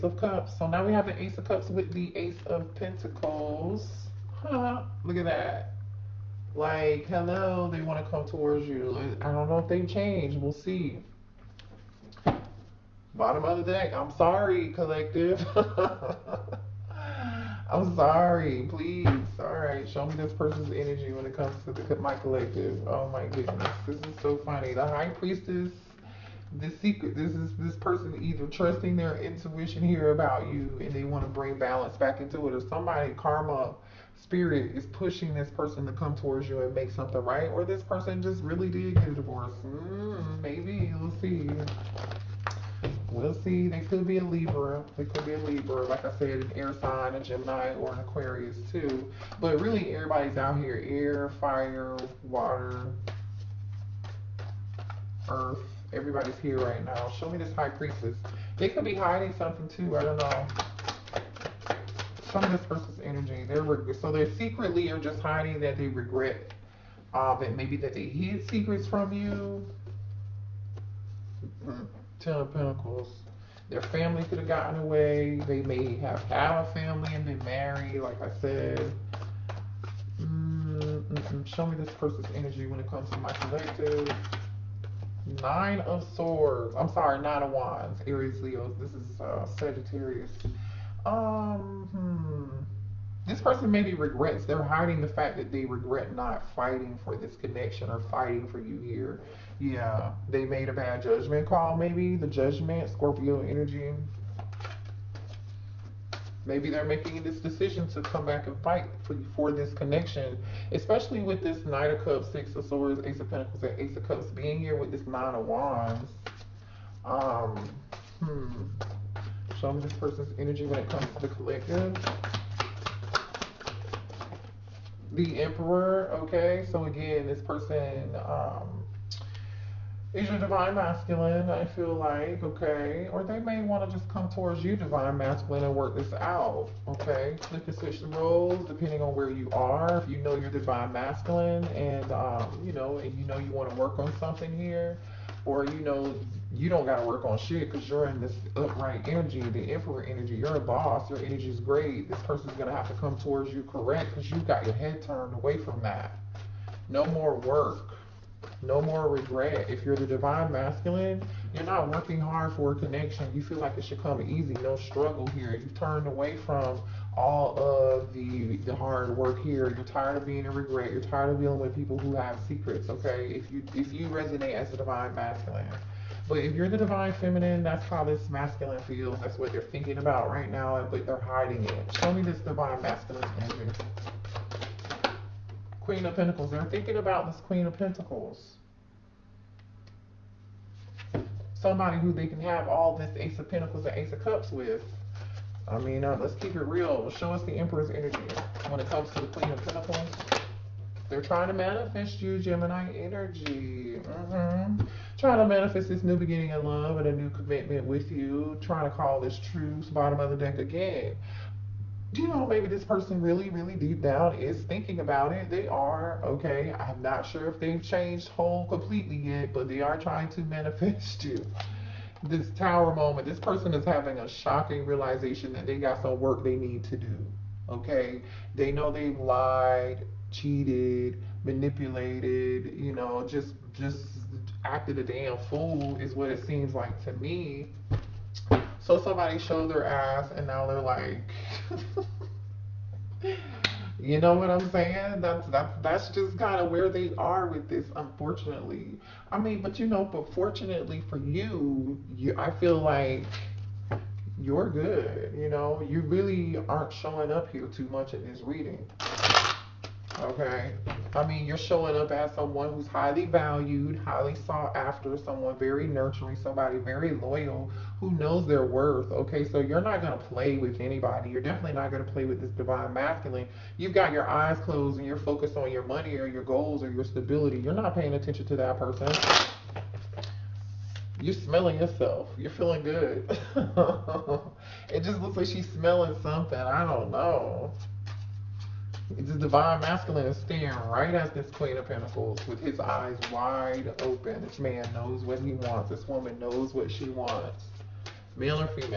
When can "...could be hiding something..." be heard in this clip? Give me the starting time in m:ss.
0:58.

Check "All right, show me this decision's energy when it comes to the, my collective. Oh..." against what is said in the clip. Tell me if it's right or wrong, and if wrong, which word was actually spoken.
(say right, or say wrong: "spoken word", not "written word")
wrong: "person", not "decision".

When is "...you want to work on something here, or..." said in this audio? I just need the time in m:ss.
2:23.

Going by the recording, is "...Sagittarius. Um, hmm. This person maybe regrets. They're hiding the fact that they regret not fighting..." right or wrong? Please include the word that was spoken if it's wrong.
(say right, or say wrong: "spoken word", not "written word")
right.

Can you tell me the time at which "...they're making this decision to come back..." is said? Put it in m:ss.
1:46.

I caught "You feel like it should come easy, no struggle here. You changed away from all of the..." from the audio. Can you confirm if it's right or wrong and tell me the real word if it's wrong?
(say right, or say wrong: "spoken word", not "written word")
wrong: "turned", not "changed".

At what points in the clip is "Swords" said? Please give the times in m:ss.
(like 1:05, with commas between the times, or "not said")
1:26, 1:52.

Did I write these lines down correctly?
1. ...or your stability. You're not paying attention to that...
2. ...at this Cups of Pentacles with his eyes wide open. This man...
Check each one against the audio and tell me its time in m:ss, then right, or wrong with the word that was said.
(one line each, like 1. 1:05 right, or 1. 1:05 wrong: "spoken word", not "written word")
1. 4:36 right
2. 4:51 wrong: "Queen", not "Cups".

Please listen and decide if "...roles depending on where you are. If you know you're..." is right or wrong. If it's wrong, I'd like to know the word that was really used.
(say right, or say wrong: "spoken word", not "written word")
right.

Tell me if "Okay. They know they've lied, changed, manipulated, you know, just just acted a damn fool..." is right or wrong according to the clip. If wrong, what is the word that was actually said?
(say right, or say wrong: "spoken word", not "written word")
wrong: "cheated", not "changed".